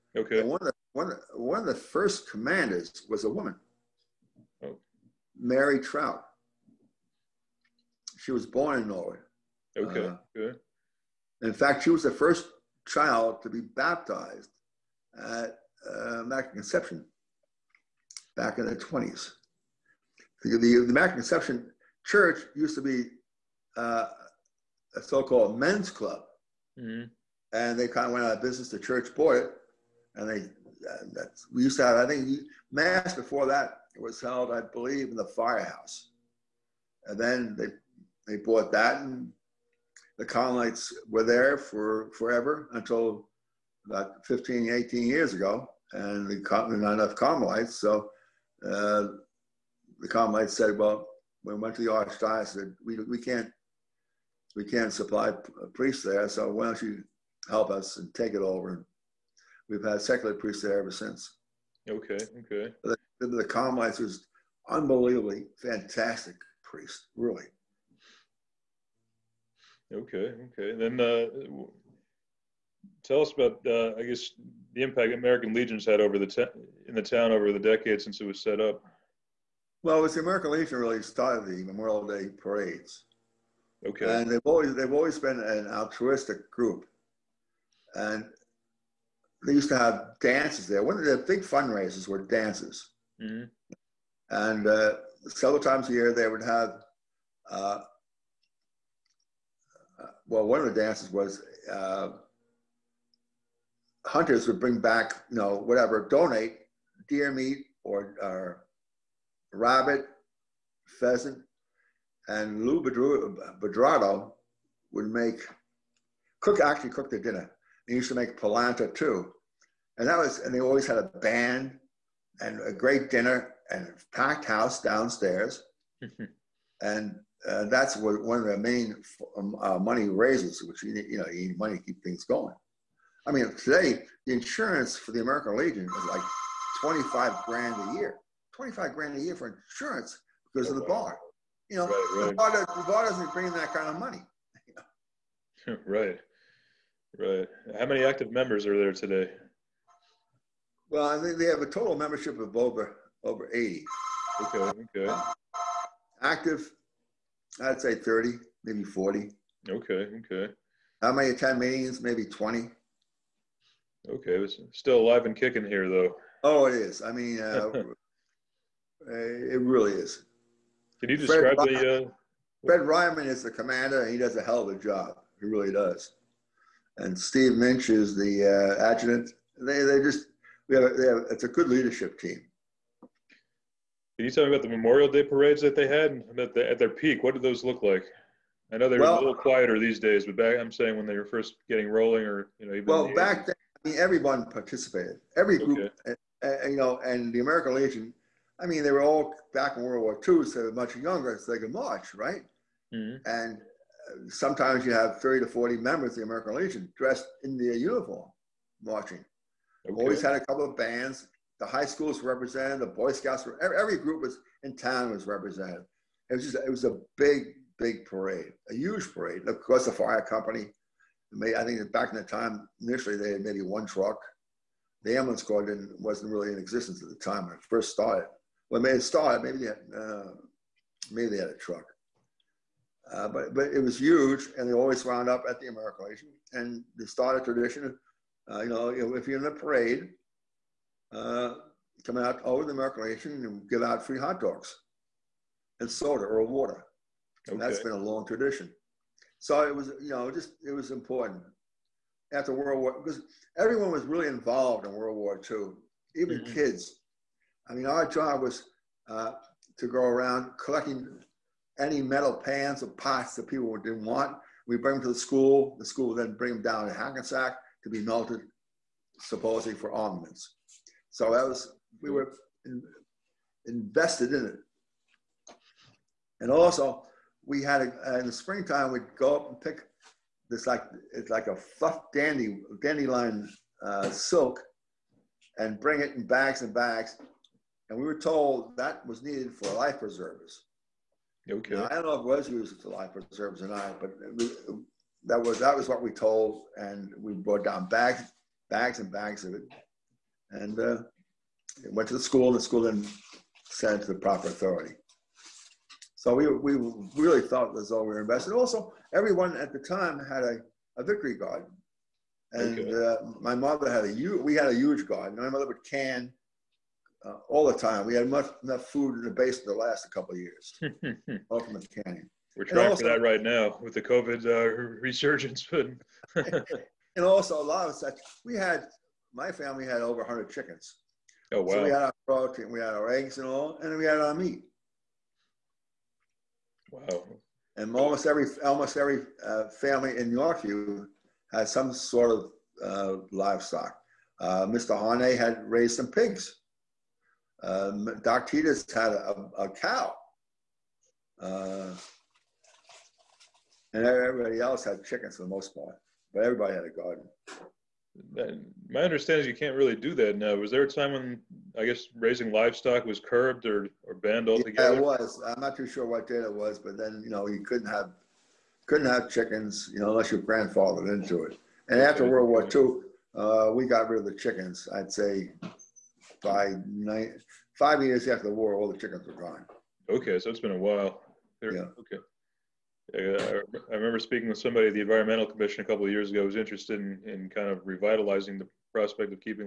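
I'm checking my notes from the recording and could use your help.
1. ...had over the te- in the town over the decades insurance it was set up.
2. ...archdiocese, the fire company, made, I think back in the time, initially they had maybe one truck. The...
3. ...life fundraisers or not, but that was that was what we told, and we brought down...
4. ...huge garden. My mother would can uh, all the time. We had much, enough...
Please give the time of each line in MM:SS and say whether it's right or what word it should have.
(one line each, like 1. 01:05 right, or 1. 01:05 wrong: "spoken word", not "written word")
1. 01:15 wrong: "since", not "insurance"
2. 03:39 wrong: "course", not "archdiocese"
3. 04:52 wrong: "preservers", not "fundraisers"
4. 05:14 right.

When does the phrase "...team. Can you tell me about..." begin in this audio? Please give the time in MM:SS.
03:02.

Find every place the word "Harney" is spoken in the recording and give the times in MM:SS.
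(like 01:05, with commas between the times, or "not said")
05:44.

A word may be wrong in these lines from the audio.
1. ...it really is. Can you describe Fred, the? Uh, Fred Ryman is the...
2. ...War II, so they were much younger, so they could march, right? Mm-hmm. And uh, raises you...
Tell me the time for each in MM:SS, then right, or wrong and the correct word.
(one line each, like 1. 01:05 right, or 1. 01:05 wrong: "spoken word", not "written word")
1. 02:49 right
2. 03:20 wrong: "sometimes", not "raises".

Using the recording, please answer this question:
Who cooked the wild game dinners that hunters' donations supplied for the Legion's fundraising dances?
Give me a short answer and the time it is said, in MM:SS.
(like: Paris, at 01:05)
Lou Bedrado, at 01:52.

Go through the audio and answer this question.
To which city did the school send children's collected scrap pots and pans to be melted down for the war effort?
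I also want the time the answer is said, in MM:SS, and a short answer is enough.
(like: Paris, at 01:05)
Hackensack, at 04:26.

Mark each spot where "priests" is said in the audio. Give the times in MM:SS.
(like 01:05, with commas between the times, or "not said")
00:55, 01:00, 01:06.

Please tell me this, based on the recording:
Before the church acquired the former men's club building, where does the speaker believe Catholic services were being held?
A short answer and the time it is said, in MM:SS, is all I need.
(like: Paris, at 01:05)
the firehouse, at 00:35.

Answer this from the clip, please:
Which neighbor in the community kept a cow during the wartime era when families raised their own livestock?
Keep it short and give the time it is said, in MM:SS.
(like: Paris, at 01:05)
Doc Titus, at 05:48.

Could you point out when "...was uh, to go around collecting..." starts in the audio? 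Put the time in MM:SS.
04:18.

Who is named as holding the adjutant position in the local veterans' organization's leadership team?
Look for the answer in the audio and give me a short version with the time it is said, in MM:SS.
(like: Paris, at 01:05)
Steve Minch, at 02:57.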